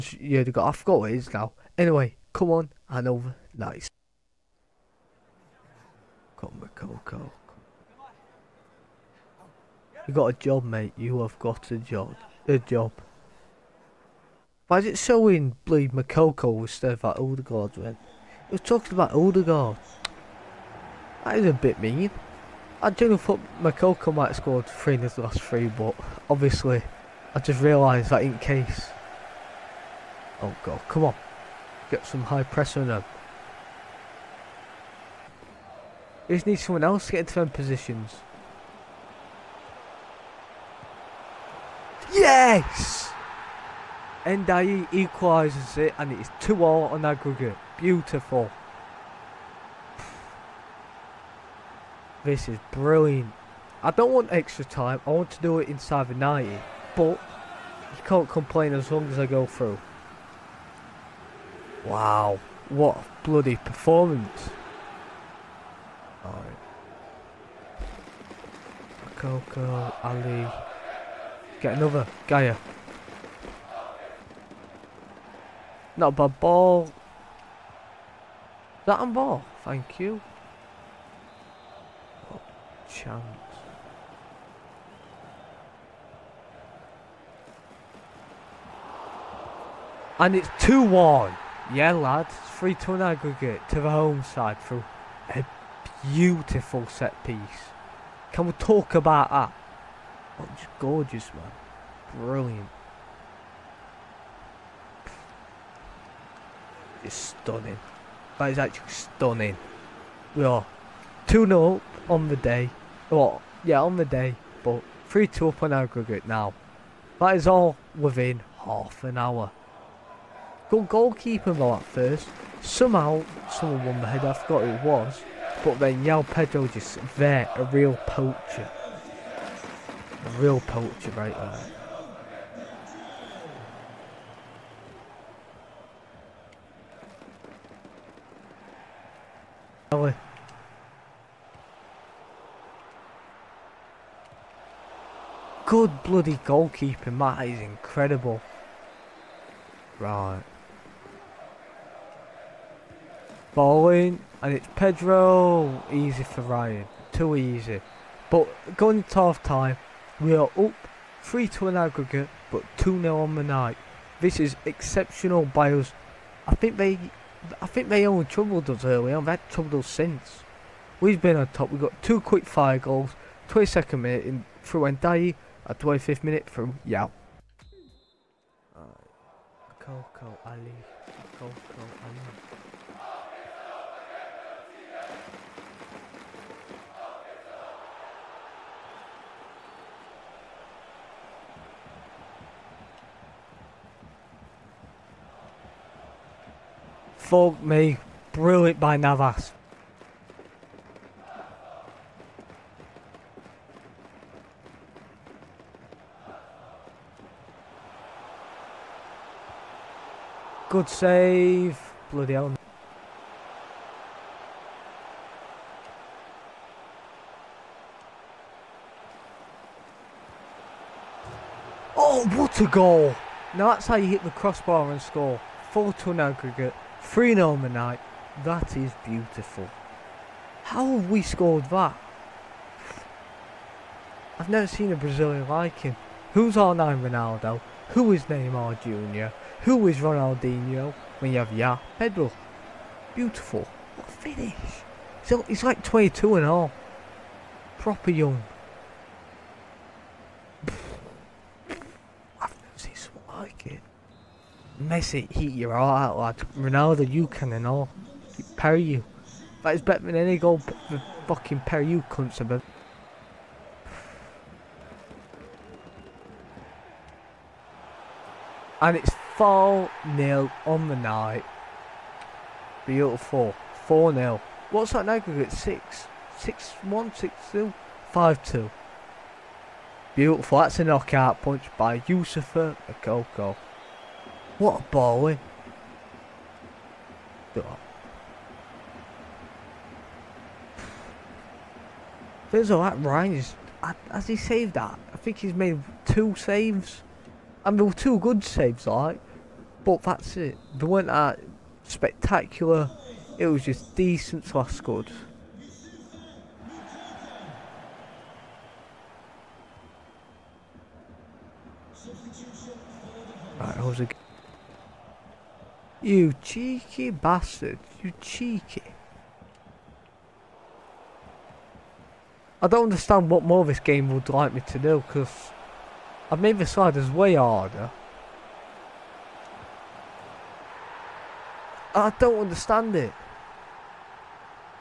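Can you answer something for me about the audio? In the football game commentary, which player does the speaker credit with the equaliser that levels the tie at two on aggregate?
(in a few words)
Ndiaye.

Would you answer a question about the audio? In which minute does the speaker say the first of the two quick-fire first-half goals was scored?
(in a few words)
22nd minute.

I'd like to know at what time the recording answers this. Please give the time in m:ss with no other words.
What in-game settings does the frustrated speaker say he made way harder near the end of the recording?
5:26.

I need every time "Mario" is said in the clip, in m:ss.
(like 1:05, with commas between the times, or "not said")
not said.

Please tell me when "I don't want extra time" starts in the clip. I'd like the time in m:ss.
0:53.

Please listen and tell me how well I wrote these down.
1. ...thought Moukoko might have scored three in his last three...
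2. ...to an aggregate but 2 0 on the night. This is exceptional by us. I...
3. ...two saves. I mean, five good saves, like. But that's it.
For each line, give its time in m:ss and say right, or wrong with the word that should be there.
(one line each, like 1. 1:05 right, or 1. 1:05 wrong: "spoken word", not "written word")
1. 0:23 right
2. 2:41 right
3. 4:56 wrong: "two", not "five".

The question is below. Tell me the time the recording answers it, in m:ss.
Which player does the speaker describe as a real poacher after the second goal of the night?
2:06.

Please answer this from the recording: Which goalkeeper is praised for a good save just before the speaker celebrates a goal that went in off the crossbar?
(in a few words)
Navas.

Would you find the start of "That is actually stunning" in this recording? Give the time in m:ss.
1:48.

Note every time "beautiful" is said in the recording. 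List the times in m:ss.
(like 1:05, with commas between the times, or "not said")
0:47, 1:36, 3:49, 4:03, 4:32, 4:40.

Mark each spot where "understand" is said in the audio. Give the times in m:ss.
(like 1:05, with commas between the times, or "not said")
5:22, 5:32.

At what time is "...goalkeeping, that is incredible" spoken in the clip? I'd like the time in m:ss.
2:26.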